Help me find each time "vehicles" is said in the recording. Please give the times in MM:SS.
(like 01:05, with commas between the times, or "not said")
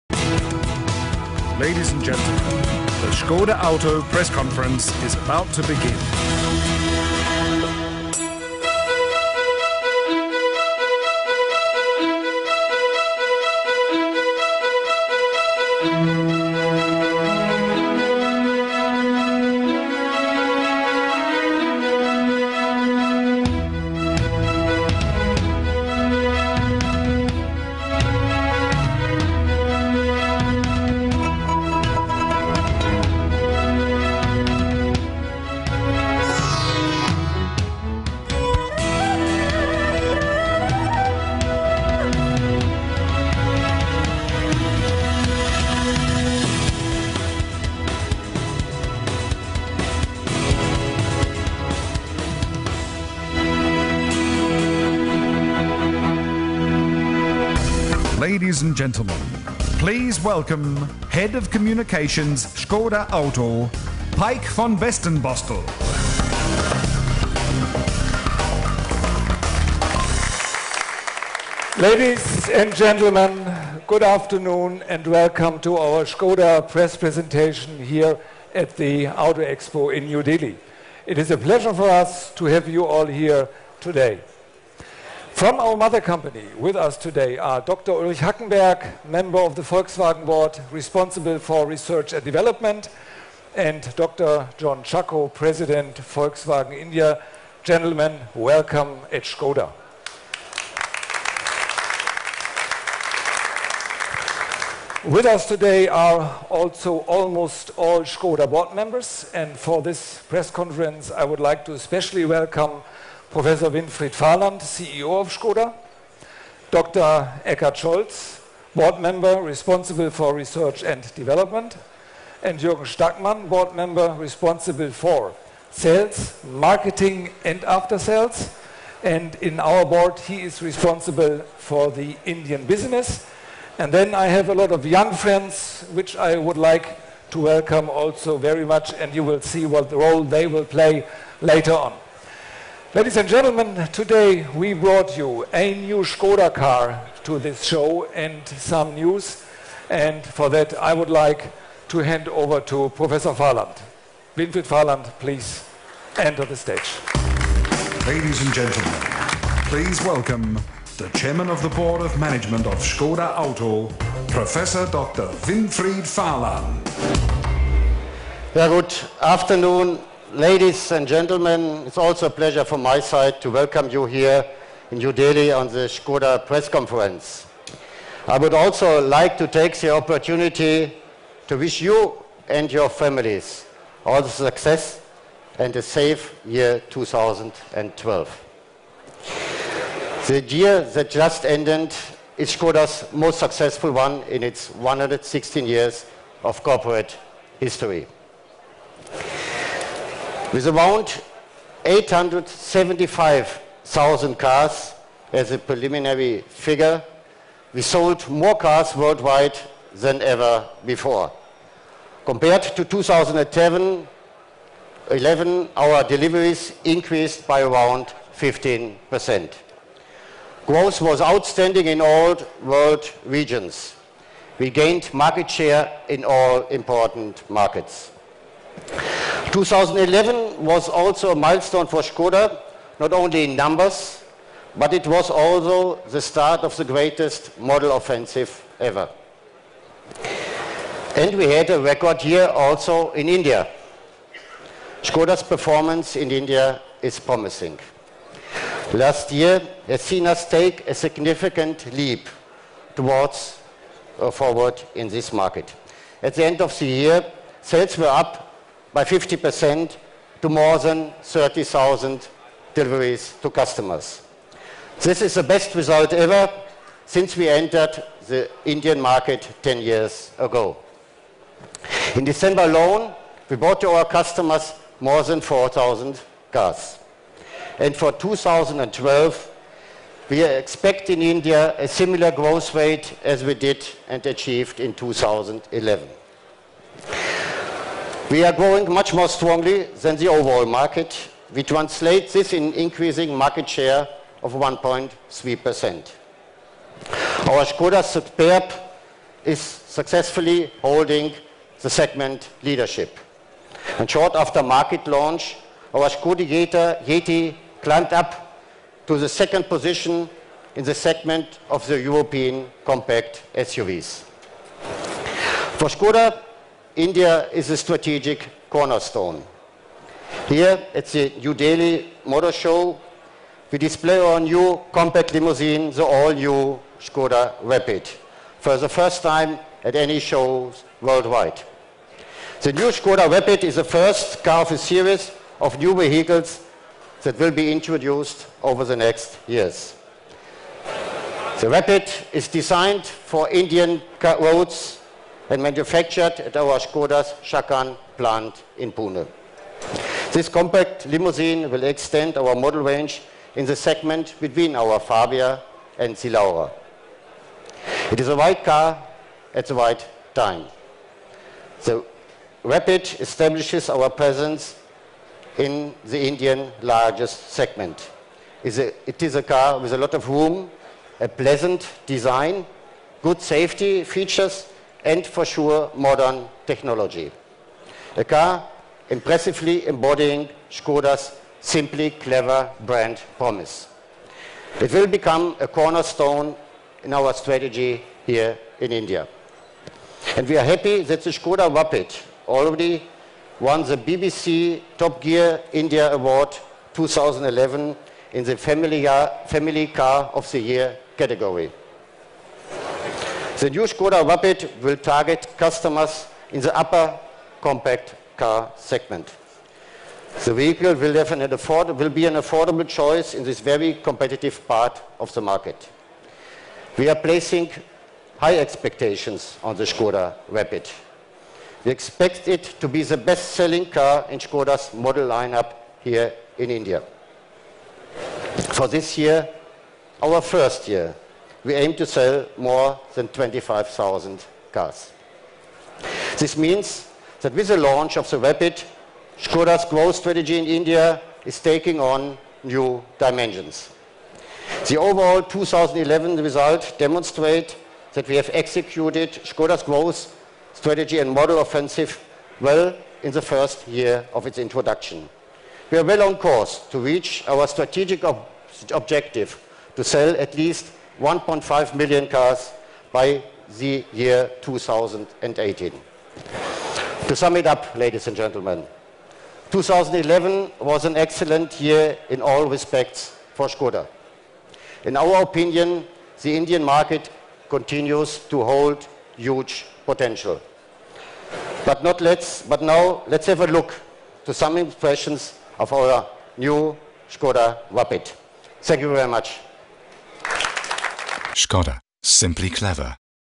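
05:35, 06:50.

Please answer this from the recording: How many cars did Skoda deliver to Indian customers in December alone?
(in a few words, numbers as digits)
more than 4,000.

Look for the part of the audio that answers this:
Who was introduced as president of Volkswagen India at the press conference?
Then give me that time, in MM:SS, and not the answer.
01:33.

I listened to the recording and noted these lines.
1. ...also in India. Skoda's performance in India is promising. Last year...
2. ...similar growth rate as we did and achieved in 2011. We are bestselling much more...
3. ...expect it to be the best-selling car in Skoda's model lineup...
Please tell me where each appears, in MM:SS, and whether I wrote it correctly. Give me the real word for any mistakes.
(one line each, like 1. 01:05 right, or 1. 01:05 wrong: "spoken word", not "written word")
1. 04:02 right
2. 04:41 wrong: "growing", not "bestselling"
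3. 07:01 right.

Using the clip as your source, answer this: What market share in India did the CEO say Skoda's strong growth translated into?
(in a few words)
1.3%.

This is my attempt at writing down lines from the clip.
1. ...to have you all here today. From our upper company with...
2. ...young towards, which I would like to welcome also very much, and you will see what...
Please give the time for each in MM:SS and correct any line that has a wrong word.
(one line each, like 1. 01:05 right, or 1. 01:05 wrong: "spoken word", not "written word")
1. 01:22 wrong: "mother", not "upper"
2. 02:14 wrong: "friends", not "towards".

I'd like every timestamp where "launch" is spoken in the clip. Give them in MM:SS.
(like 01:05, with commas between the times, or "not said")
05:05, 07:17.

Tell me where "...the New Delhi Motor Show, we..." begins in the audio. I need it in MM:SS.
05:21.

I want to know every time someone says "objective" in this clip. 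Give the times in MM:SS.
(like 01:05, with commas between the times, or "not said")
07:38.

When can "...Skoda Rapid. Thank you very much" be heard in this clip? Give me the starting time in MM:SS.
08:07.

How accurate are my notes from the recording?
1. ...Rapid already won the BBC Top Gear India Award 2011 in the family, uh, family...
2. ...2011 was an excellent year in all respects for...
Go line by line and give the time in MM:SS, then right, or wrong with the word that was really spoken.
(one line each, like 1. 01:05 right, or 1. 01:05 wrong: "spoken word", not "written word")
1. 06:31 right
2. 07:49 right.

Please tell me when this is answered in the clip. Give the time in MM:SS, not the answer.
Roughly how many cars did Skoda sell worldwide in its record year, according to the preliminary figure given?
03:21.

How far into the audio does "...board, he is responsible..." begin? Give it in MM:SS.
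02:09.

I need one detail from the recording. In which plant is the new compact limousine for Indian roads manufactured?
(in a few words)
Chakan plant in Pune.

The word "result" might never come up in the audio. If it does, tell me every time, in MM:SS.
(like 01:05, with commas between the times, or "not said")
04:25, 07:26.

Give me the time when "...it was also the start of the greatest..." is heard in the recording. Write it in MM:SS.
03:54.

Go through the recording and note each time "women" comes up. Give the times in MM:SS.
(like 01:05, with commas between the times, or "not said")
not said.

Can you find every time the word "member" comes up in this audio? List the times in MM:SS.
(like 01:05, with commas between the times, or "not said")
01:29, 01:48, 01:58, 02:03.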